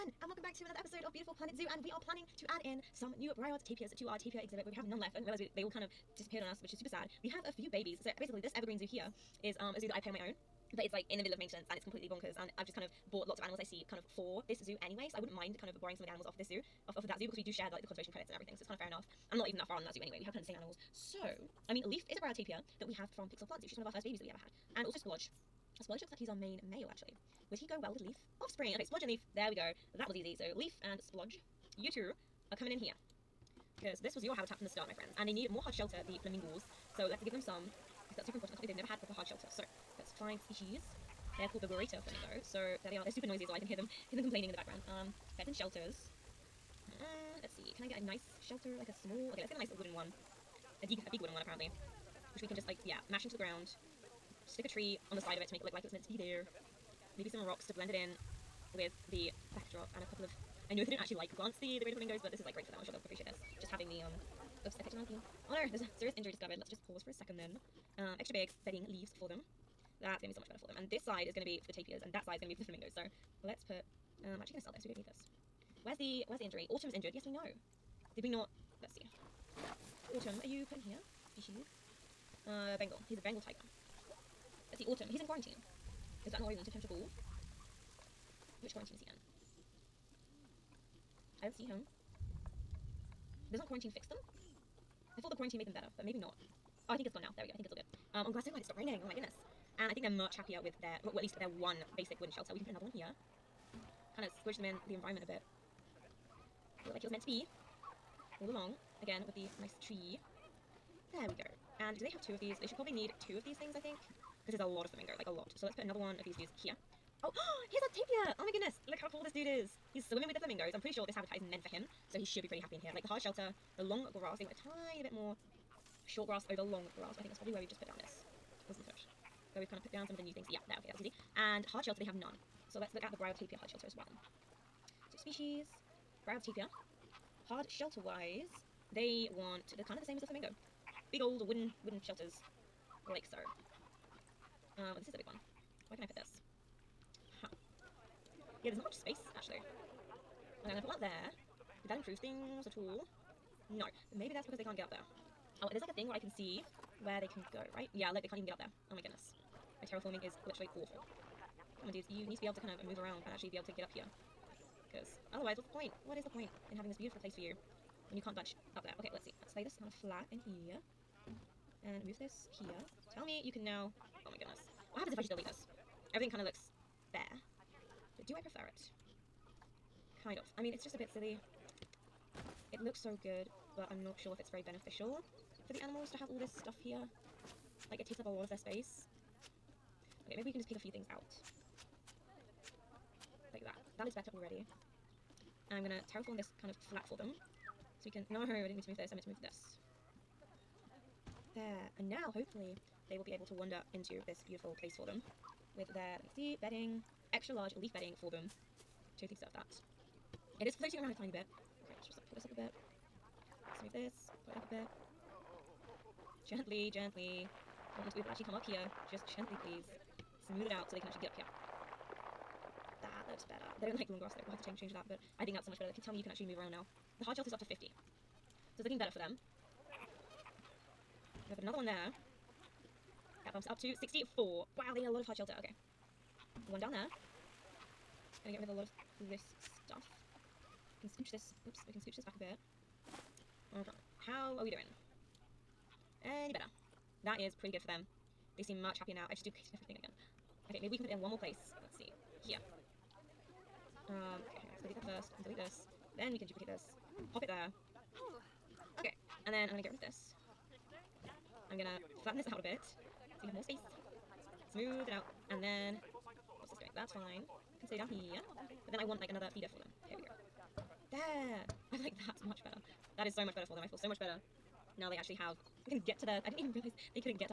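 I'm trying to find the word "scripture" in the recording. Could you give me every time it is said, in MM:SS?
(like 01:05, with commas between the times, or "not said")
not said.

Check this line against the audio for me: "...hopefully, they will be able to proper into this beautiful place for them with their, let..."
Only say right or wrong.
wrong.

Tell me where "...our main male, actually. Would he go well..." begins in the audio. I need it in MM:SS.
00:26.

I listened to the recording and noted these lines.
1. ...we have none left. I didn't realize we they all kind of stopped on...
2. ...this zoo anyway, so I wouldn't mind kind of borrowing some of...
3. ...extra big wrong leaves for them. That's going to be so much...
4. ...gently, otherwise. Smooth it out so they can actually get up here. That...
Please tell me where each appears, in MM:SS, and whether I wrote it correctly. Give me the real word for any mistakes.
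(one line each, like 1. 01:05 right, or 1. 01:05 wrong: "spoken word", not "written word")
1. 00:04 wrong: "disappeared", not "stopped"
2. 00:14 right
3. 01:08 wrong: "bedding", not "wrong"
4. 03:39 wrong: "please", not "otherwise".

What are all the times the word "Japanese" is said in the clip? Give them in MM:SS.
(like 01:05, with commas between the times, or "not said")
not said.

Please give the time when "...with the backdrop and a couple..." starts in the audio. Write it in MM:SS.
00:58.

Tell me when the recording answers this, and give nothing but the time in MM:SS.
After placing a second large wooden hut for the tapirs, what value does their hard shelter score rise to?
03:54.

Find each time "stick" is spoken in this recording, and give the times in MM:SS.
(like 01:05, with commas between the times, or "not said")
00:54.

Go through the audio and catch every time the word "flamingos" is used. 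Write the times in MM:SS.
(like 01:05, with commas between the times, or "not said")
00:36, 00:42, 01:01, 01:12, 01:54, 02:00, 02:20.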